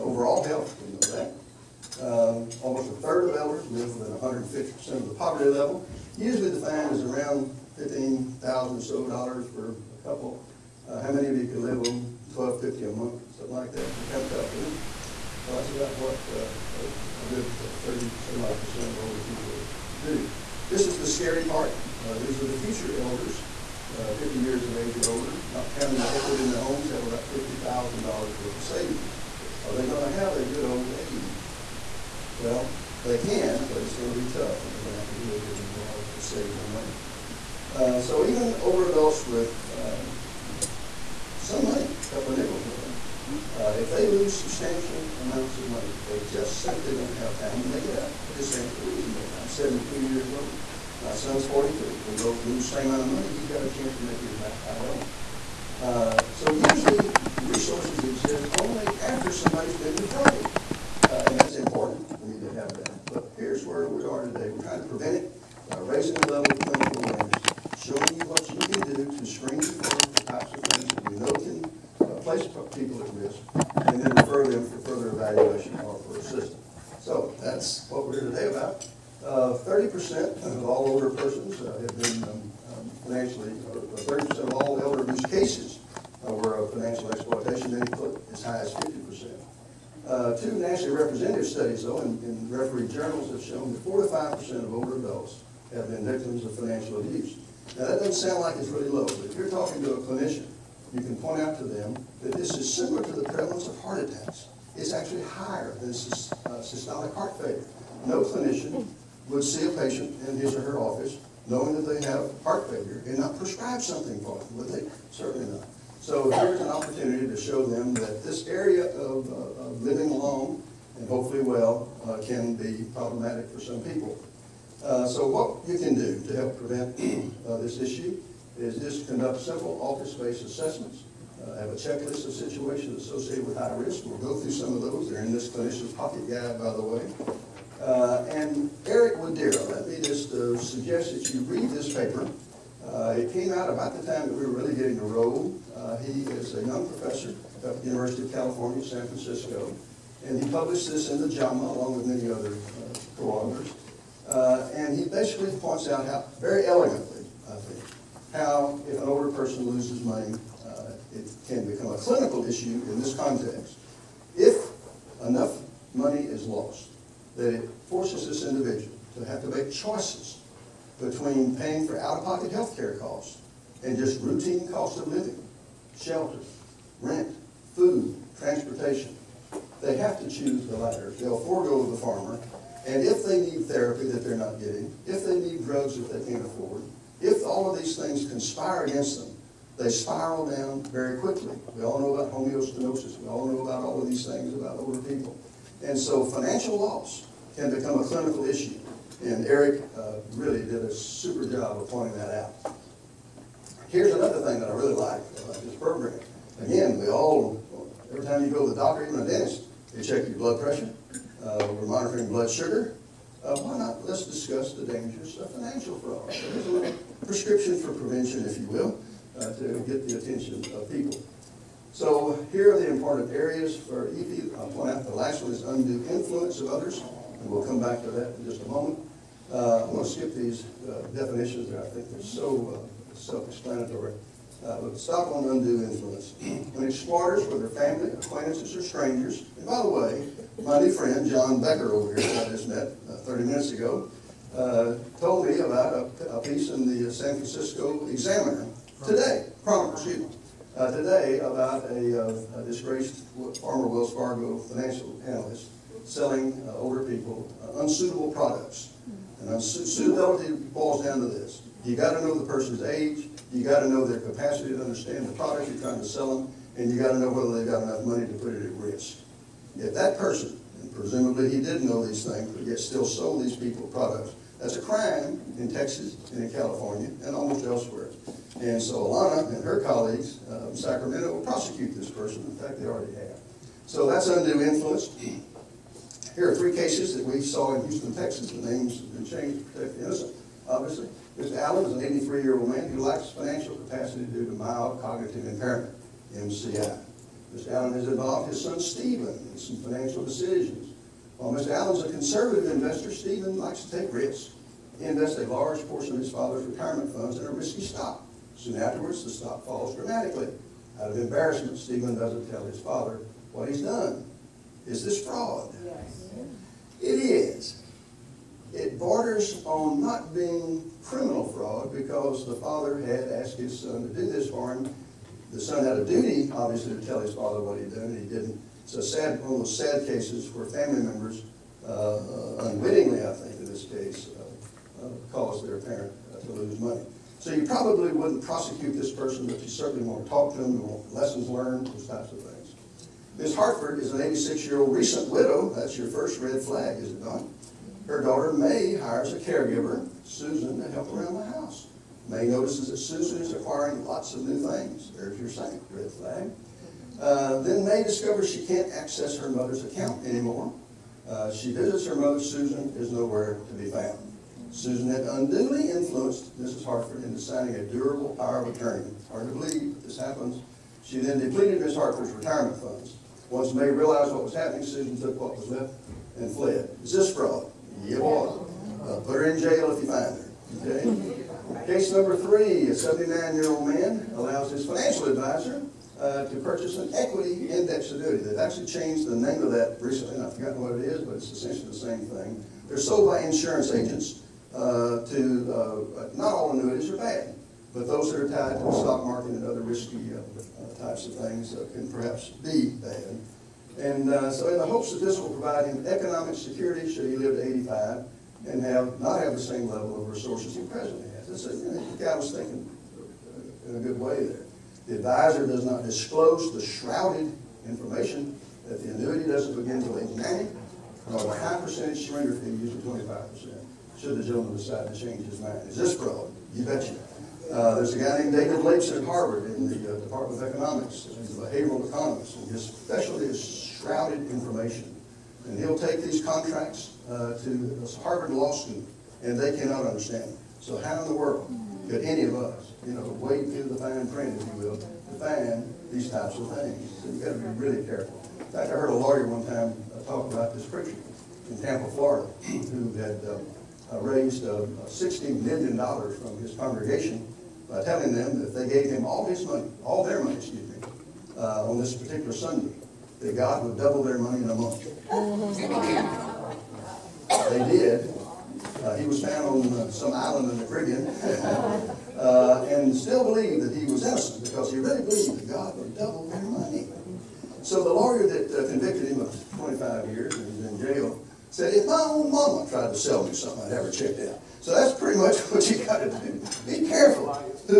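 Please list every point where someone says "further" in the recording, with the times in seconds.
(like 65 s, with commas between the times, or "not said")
74 s.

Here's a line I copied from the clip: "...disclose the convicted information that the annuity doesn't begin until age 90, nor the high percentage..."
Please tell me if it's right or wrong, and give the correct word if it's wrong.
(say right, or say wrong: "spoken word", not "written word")
wrong: "shrouded", not "convicted".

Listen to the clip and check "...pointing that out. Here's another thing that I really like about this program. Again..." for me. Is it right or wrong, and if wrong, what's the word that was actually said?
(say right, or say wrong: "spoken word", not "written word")
right.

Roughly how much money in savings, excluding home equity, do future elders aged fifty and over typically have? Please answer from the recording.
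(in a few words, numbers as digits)
$50,000.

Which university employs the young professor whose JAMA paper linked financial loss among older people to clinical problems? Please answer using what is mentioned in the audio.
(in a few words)
University of California, San Francisco.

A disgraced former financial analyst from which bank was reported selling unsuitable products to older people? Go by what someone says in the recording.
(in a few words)
Wells Fargo.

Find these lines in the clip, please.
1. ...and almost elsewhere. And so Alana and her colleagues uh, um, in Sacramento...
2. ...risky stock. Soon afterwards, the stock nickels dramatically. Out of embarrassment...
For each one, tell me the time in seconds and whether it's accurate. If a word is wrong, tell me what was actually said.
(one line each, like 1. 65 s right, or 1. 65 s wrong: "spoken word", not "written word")
1. 277 s right
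2. 307 s wrong: "falls", not "nickels".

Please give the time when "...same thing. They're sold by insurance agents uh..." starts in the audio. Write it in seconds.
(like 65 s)
391 s.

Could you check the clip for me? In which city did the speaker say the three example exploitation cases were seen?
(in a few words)
Houston, Texas.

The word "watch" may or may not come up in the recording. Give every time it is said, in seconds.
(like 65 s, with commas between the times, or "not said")
not said.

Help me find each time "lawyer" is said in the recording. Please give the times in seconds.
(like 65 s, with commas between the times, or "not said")
449 s, 478 s.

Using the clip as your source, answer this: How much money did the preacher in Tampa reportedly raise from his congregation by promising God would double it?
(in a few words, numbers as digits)
$60 million.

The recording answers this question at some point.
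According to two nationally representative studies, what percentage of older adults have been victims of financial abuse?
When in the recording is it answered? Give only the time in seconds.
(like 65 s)
93 s.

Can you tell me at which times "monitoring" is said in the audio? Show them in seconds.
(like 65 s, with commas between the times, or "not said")
211 s.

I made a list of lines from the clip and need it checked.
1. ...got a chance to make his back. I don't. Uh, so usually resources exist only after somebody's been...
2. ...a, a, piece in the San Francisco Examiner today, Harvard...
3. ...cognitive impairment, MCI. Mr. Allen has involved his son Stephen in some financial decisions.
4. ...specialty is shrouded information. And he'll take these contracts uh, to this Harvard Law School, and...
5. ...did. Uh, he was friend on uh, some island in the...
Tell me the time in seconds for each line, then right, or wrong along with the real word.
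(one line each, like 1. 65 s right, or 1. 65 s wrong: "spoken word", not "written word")
1. 53 s right
2. 246 s wrong: "Chronicle", not "Harvard"
3. 295 s right
4. 432 s right
5. 467 s wrong: "found", not "friend".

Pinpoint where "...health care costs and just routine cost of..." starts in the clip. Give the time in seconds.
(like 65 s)
172 s.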